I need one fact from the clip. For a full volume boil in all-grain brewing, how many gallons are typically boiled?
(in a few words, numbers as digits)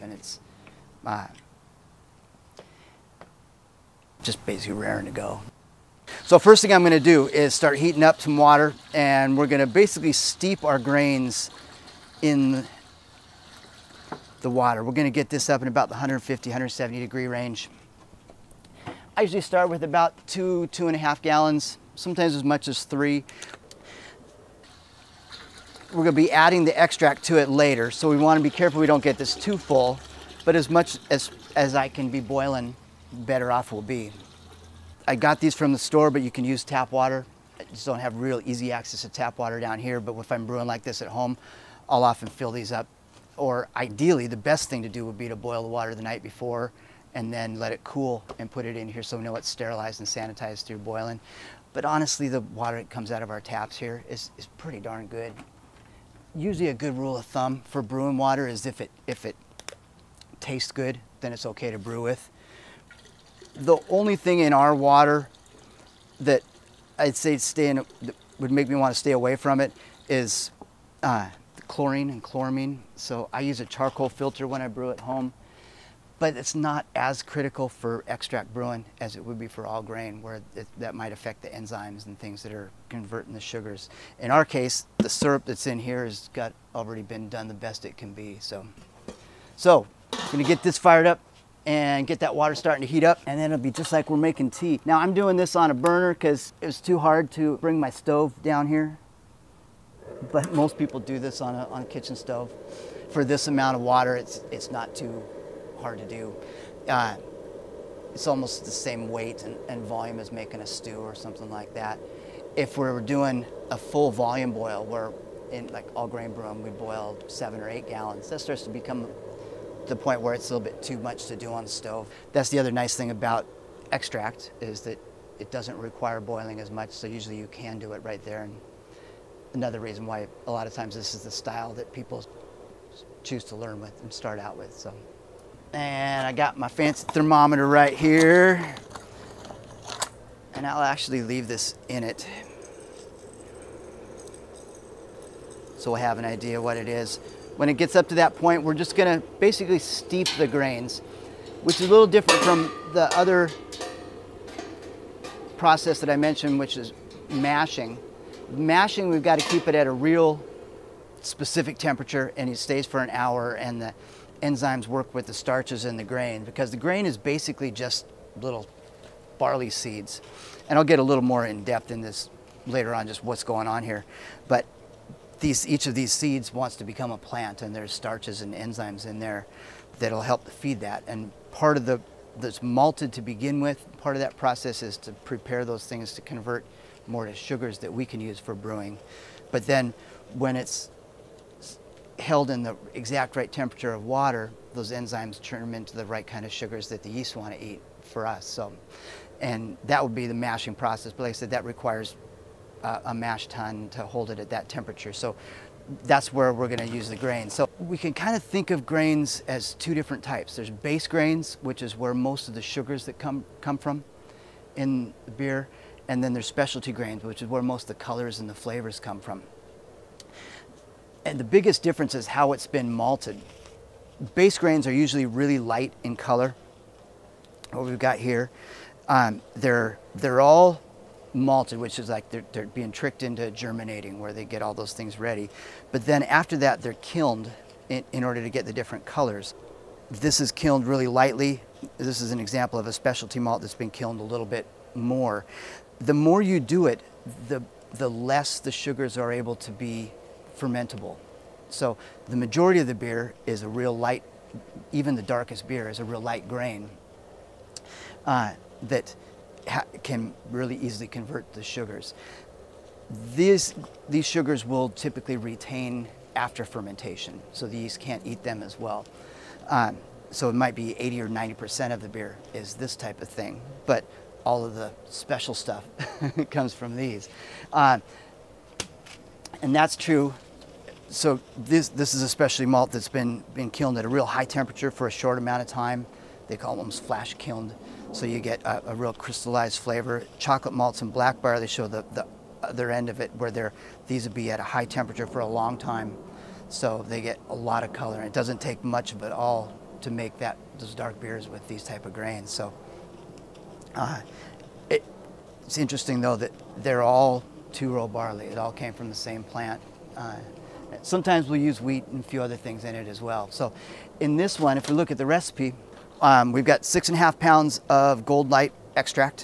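7 or 8 gallons.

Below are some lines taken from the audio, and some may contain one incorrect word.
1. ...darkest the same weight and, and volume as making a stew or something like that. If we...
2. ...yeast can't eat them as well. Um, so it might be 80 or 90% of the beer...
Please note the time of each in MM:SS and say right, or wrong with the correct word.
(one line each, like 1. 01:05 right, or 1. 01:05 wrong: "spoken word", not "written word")
1. 01:48 wrong: "almost", not "darkest"
2. 04:27 right.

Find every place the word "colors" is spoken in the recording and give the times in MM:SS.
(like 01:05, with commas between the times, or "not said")
03:38, 03:46, 03:59, 04:57.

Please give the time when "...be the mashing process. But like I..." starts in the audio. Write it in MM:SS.
03:20.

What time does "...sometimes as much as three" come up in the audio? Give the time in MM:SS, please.
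00:21.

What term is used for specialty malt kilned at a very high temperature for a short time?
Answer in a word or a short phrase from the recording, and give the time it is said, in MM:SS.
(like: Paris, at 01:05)
flash kilned, at 04:46.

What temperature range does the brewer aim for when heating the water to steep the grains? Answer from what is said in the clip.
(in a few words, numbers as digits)
150-170 degrees.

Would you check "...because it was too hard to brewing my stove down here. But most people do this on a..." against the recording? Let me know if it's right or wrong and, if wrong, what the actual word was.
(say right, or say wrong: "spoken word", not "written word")
wrong: "bring", not "brewing".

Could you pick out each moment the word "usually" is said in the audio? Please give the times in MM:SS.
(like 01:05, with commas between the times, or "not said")
00:19, 00:56, 02:07, 03:44.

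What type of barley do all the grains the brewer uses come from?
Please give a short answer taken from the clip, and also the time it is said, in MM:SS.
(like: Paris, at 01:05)
two-row barley, at 05:07.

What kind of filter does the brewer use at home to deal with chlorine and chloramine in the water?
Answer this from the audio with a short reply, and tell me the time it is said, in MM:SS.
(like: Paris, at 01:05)
charcoal filter, at 01:13.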